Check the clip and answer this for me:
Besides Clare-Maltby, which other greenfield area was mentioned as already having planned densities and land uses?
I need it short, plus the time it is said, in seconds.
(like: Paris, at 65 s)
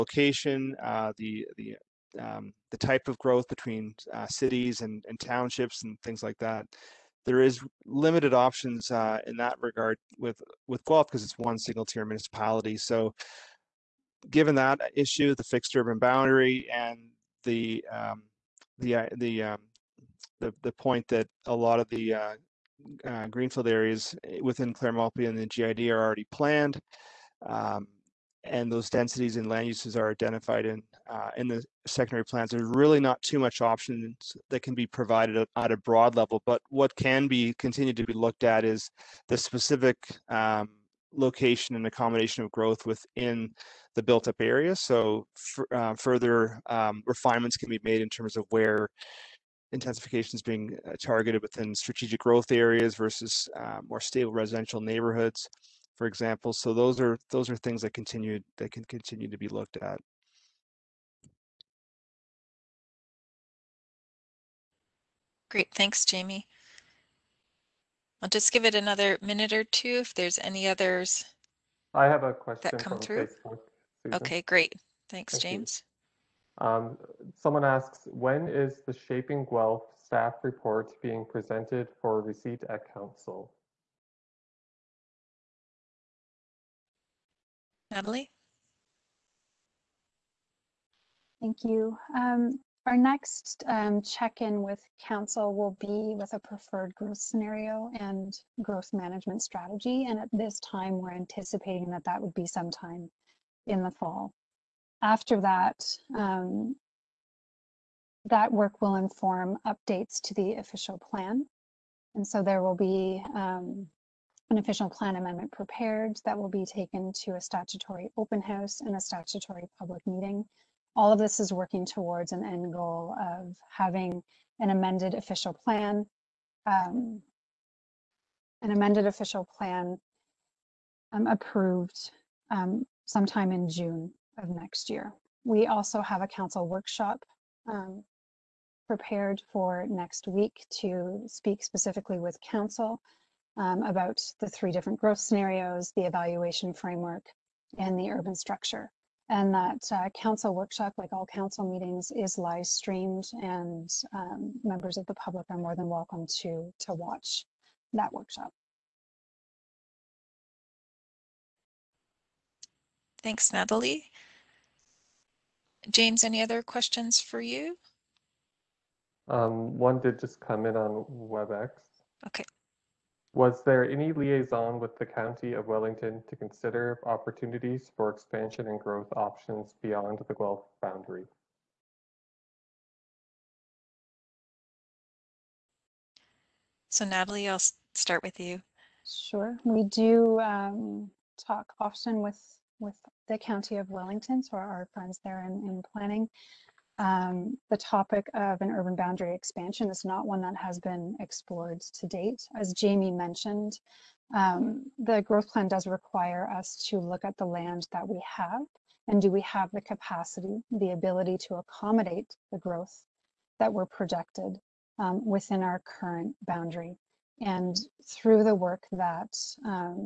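GID, at 25 s.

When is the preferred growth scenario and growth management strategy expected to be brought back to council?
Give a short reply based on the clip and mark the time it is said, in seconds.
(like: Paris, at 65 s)
In the fall, at 102 s.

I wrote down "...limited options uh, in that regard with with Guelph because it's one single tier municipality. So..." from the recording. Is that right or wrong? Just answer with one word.
right.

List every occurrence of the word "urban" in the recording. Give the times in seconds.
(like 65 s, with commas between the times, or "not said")
15 s, 148 s, 198 s.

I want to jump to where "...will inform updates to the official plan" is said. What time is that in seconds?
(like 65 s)
108 s.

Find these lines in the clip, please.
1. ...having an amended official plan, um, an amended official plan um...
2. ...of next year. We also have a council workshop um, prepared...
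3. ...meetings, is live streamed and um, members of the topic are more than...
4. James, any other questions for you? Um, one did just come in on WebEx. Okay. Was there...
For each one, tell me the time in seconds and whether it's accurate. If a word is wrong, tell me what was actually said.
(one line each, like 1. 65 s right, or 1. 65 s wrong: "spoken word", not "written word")
1. 123 s right
2. 134 s right
3. 151 s wrong: "public", not "topic"
4. 165 s right.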